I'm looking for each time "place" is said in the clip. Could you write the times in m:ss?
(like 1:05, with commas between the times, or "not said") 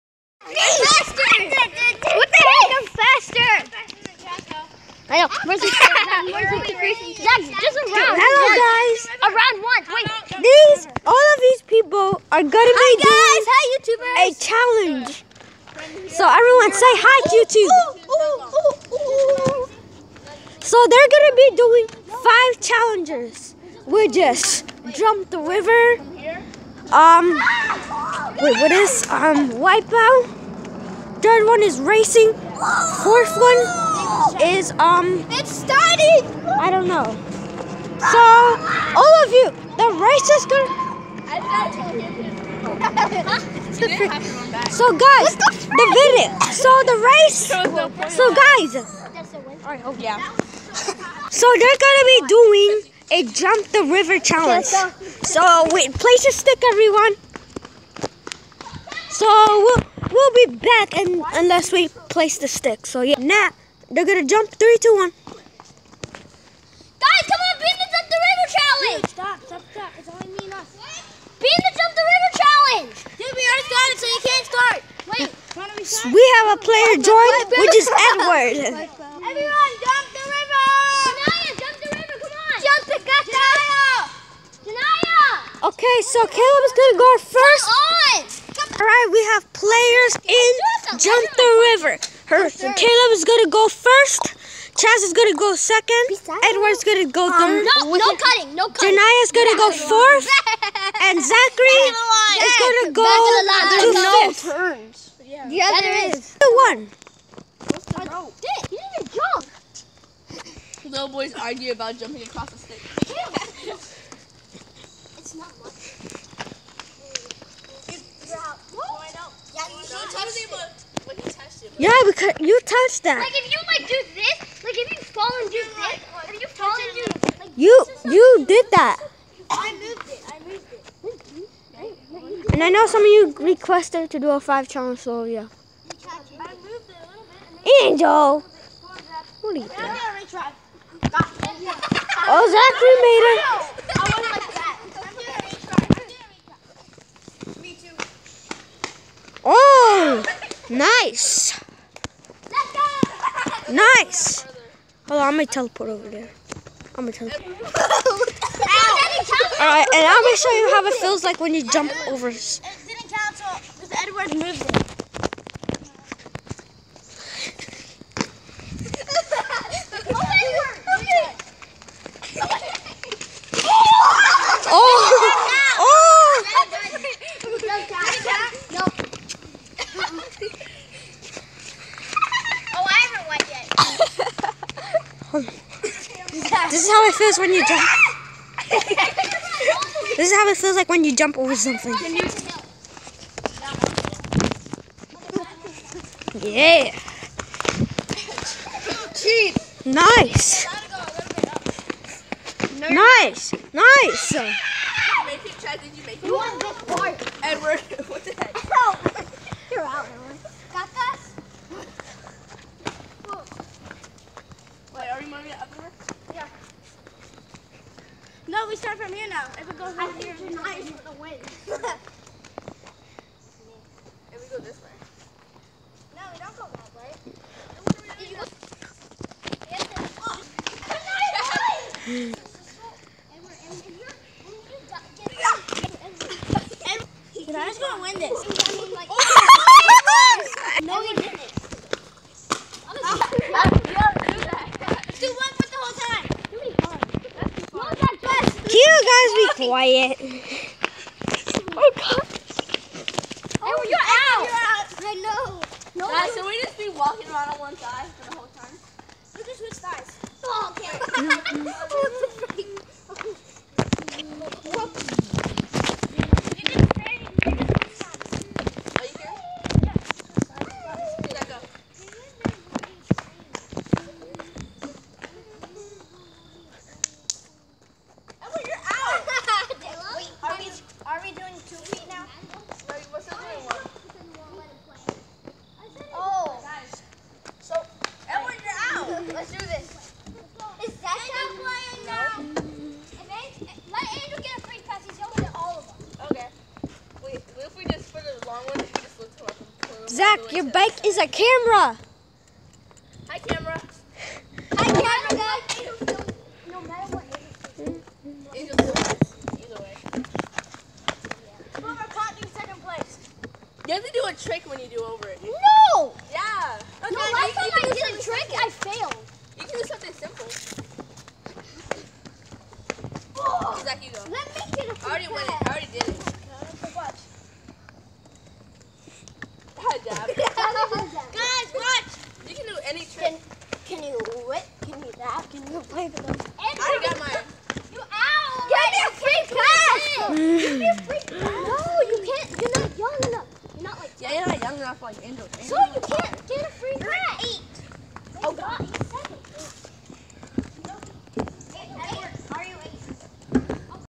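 0:55, 1:02, 5:12.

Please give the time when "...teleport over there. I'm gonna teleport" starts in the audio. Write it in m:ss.
2:35.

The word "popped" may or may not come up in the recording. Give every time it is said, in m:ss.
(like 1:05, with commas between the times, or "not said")
not said.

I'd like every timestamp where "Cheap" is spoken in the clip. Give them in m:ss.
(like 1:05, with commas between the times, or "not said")
3:19.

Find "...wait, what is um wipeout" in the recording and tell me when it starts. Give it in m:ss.
0:28.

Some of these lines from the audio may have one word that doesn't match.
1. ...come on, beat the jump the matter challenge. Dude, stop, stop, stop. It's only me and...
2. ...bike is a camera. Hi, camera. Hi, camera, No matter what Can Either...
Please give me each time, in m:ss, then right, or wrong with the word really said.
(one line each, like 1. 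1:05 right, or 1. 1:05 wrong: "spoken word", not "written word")
1. 1:07 wrong: "river", not "matter"
2. 5:00 wrong: "Angel", not "Can".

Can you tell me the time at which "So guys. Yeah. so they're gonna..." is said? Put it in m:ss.
0:48.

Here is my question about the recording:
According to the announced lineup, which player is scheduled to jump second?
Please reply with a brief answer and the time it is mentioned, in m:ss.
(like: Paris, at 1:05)
Chaz, at 1:34.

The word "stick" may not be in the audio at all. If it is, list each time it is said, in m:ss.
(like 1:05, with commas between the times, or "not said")
0:56, 1:02, 1:52.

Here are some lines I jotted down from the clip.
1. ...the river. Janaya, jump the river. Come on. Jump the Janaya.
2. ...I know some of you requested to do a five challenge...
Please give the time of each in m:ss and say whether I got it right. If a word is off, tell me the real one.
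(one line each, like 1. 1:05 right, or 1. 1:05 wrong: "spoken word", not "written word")
1. 1:20 right
2. 2:12 right.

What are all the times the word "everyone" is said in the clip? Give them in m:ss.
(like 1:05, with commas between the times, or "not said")
0:16, 0:56, 1:19.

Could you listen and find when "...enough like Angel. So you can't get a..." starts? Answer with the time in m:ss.
5:44.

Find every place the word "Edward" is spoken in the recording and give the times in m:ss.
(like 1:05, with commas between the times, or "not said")
1:17, 1:36, 2:44, 3:27.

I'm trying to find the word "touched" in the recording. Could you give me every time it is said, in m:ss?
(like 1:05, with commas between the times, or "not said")
2:02.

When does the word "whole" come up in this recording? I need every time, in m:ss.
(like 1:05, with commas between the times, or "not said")
4:18.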